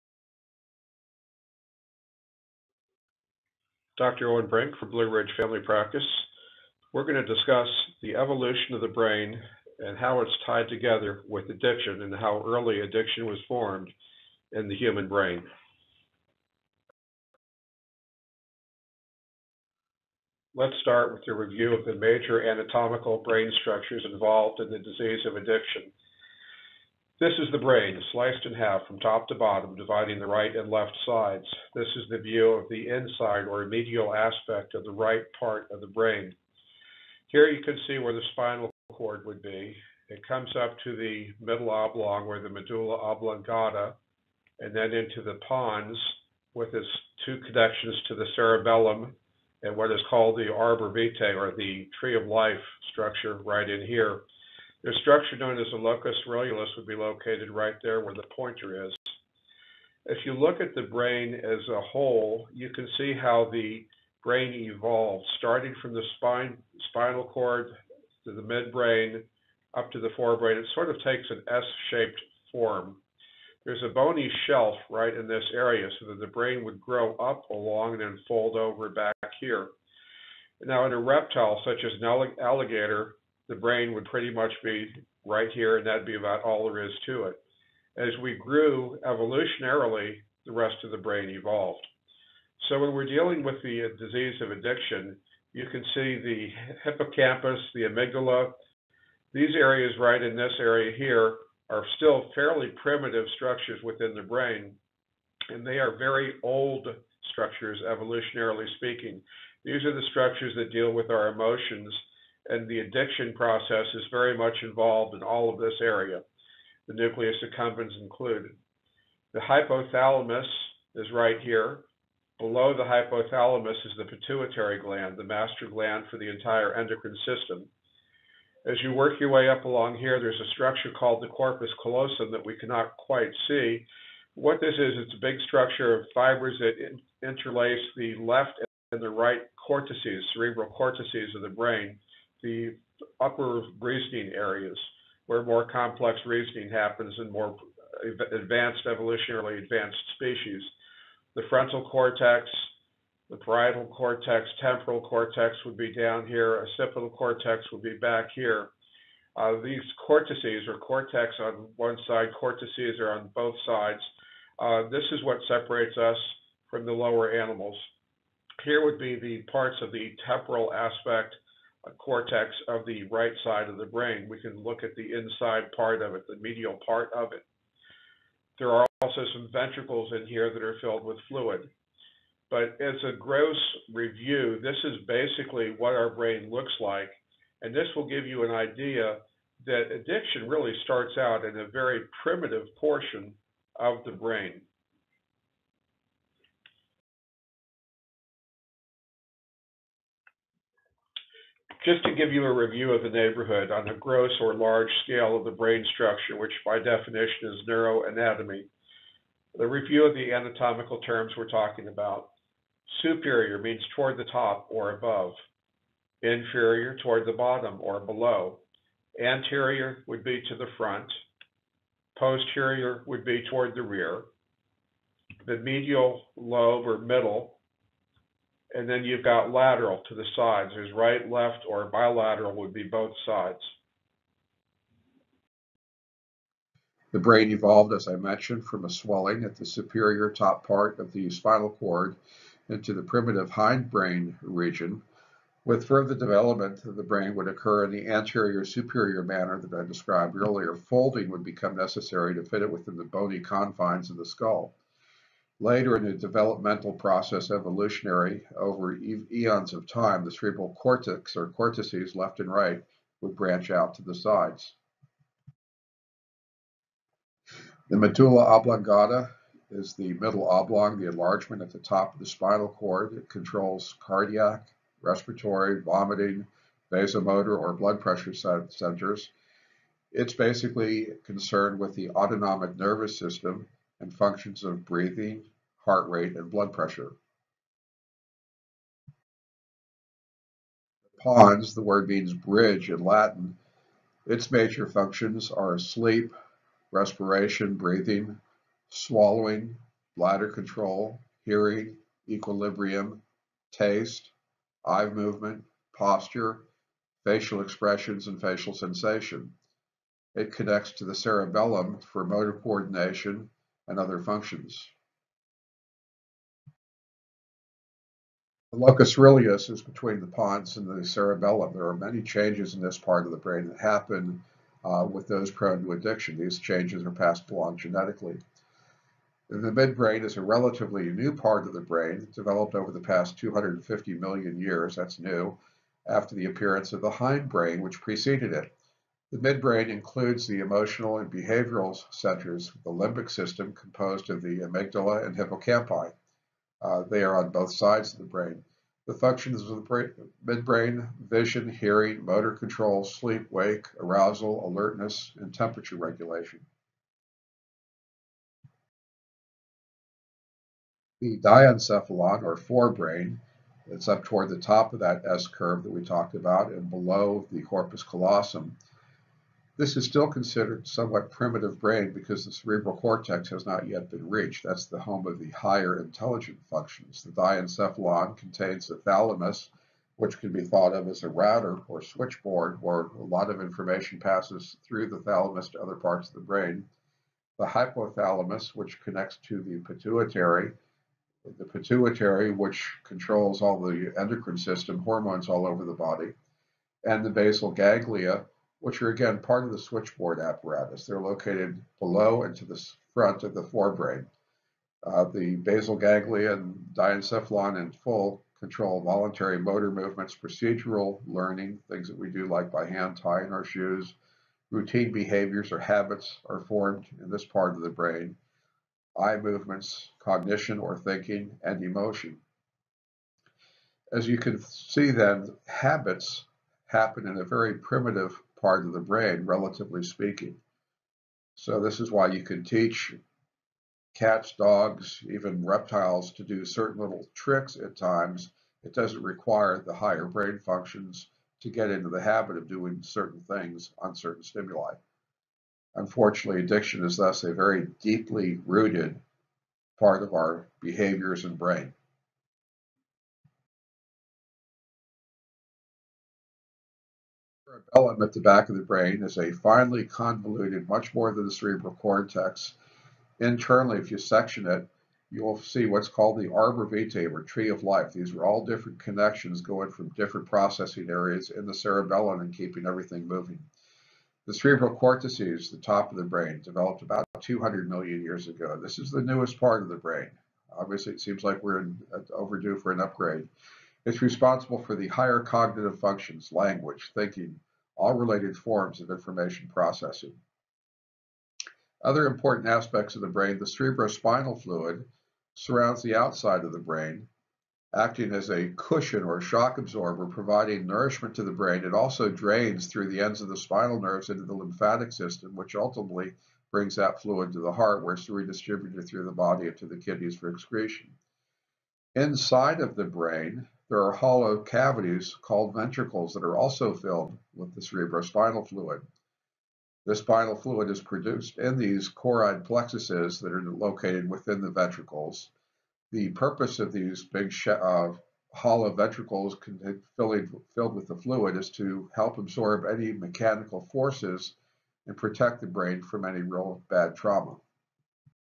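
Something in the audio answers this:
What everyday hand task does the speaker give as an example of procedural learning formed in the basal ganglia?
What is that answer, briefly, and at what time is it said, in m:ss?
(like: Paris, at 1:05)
tying our shoes, at 6:53.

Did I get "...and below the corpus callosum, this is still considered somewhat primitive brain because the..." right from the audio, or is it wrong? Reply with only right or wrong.
right.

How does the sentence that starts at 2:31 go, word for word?
The frontal cortex, the parietal cortex, temporal cortex would be down here, occipital cortex would be back here.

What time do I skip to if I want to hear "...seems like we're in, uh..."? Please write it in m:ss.
8:01.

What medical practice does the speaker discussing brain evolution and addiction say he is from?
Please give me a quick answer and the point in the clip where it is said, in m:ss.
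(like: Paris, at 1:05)
Blue Ridge Family Practice, at 0:04.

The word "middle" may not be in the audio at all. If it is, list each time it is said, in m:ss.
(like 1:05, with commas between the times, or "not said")
0:41, 3:46, 4:30.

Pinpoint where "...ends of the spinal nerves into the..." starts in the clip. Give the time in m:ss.
8:23.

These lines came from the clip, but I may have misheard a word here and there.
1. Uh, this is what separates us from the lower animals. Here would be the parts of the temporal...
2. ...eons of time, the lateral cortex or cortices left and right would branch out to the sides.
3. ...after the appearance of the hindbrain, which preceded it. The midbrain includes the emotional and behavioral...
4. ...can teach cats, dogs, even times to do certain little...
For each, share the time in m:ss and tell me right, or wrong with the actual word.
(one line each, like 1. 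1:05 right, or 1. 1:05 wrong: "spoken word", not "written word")
1. 2:44 right
2. 4:18 wrong: "cerebral", not "lateral"
3. 5:36 right
4. 7:12 wrong: "reptiles", not "times".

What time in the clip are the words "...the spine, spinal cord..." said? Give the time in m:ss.
1:05.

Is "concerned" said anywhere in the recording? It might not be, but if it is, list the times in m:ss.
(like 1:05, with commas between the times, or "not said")
4:41.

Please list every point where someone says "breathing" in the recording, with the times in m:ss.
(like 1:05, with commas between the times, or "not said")
4:44, 4:57.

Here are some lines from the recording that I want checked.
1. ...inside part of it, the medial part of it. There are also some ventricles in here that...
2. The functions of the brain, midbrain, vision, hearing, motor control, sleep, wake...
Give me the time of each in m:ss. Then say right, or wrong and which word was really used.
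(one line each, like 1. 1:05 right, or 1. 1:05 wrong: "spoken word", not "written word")
1. 2:55 right
2. 5:49 right.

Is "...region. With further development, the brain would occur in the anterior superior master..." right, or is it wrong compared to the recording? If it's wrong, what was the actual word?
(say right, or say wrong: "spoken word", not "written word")
wrong: "manner", not "master".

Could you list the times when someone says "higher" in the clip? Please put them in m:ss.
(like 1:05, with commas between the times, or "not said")
6:15, 7:19, 8:05.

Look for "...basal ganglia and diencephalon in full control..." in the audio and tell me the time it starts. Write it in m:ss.
6:45.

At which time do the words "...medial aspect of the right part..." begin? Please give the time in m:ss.
0:33.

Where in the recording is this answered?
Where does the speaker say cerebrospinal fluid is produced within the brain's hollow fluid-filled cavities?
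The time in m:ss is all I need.
8:42.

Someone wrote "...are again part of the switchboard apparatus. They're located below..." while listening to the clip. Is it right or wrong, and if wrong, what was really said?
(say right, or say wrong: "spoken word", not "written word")
right.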